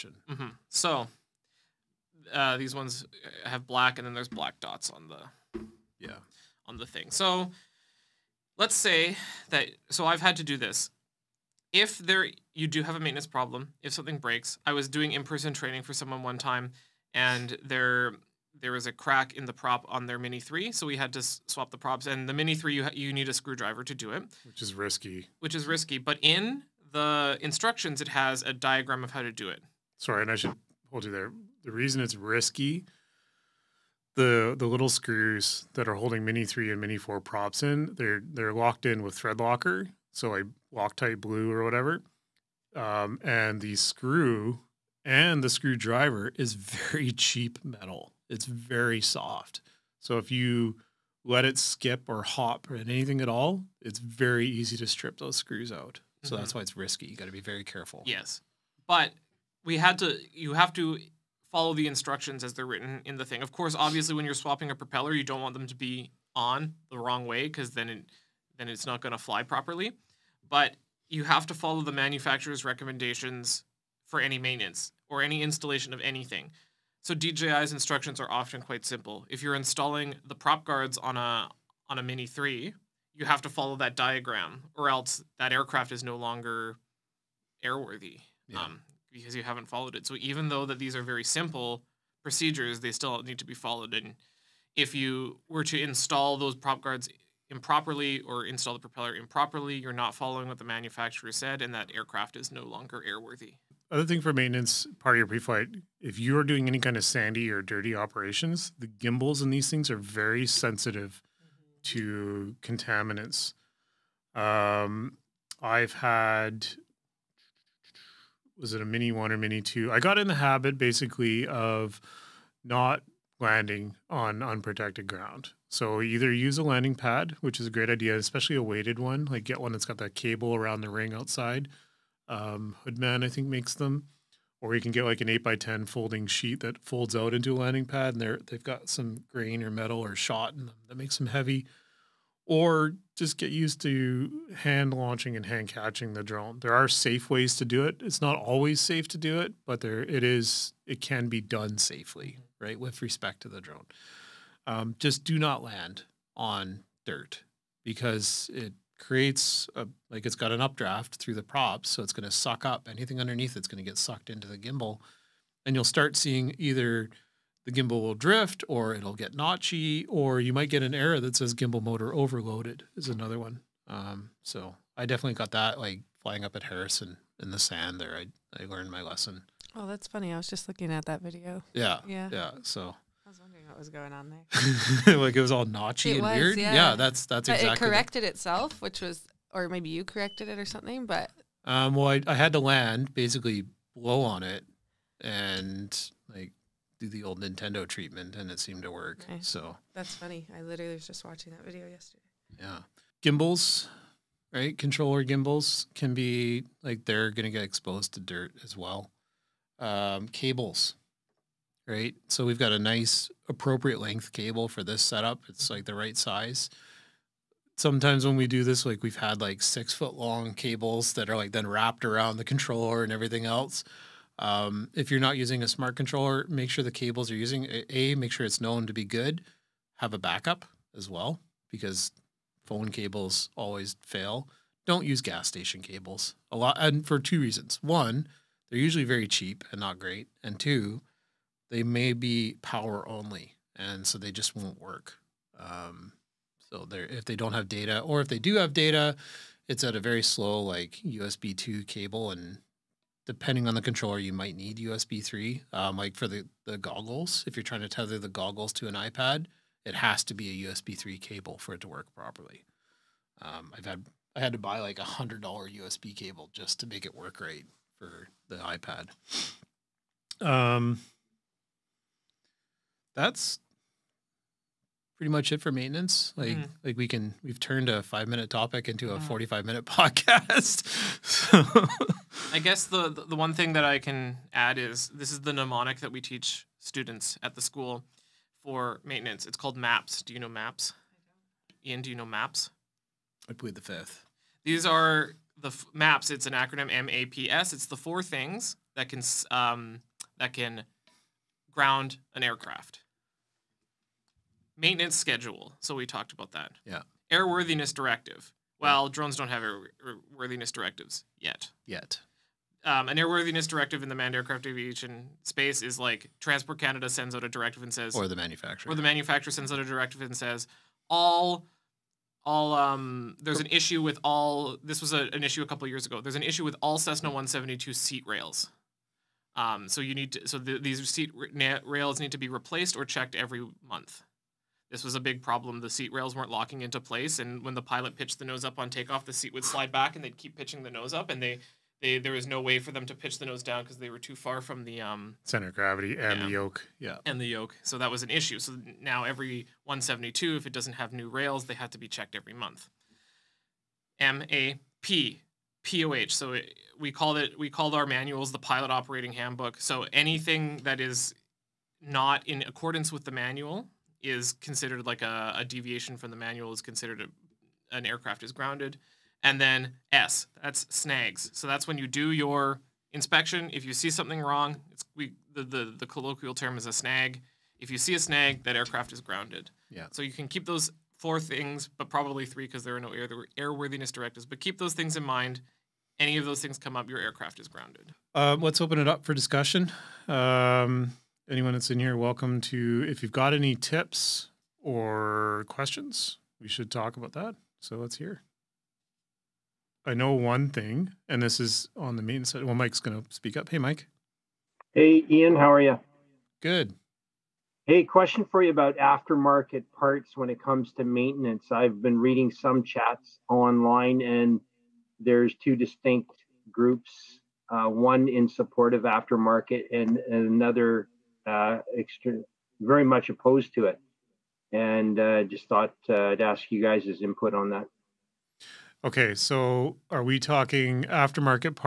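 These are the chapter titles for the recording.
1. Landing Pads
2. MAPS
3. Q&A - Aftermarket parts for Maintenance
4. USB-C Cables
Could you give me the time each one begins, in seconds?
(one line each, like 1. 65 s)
1. 131 s
2. 287 s
3. 411 s
4. 251 s.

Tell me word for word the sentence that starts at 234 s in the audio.
Don't use gas station cables a lot, and for two reasons.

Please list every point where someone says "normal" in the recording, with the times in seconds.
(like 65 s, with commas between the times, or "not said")
not said.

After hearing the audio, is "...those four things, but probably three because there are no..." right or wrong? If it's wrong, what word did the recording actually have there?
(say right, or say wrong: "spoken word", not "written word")
right.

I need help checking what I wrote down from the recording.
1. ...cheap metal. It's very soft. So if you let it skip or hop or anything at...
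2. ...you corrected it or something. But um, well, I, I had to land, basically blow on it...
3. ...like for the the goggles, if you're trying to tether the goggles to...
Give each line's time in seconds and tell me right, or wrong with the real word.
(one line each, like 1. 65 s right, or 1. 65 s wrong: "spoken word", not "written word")
1. 47 s right
2. 189 s right
3. 255 s right.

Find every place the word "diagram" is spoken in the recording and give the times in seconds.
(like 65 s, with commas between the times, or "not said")
28 s, 83 s.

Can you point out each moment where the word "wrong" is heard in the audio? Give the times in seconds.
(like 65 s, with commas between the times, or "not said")
66 s, 374 s.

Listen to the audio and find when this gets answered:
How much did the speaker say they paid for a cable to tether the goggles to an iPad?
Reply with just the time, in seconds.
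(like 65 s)
265 s.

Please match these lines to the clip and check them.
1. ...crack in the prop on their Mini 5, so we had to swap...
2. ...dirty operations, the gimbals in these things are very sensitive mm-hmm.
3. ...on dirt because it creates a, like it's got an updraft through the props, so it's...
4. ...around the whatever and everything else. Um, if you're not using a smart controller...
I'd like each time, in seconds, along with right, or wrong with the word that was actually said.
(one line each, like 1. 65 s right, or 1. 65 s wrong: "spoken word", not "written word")
1. 18 s wrong: "3", not "5"
2. 107 s right
3. 156 s right
4. 222 s wrong: "controller", not "whatever".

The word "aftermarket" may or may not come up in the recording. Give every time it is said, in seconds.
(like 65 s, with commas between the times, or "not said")
408 s, 419 s, 431 s.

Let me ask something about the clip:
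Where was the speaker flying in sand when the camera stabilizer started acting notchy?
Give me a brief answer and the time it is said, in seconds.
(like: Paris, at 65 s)
Harrison, at 176 s.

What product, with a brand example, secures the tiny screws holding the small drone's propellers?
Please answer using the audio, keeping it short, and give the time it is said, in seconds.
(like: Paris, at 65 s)
Loctite blue, at 40 s.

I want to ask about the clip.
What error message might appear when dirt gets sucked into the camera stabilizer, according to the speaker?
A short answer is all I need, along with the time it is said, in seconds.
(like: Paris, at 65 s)
gimbal motor overloaded, at 171 s.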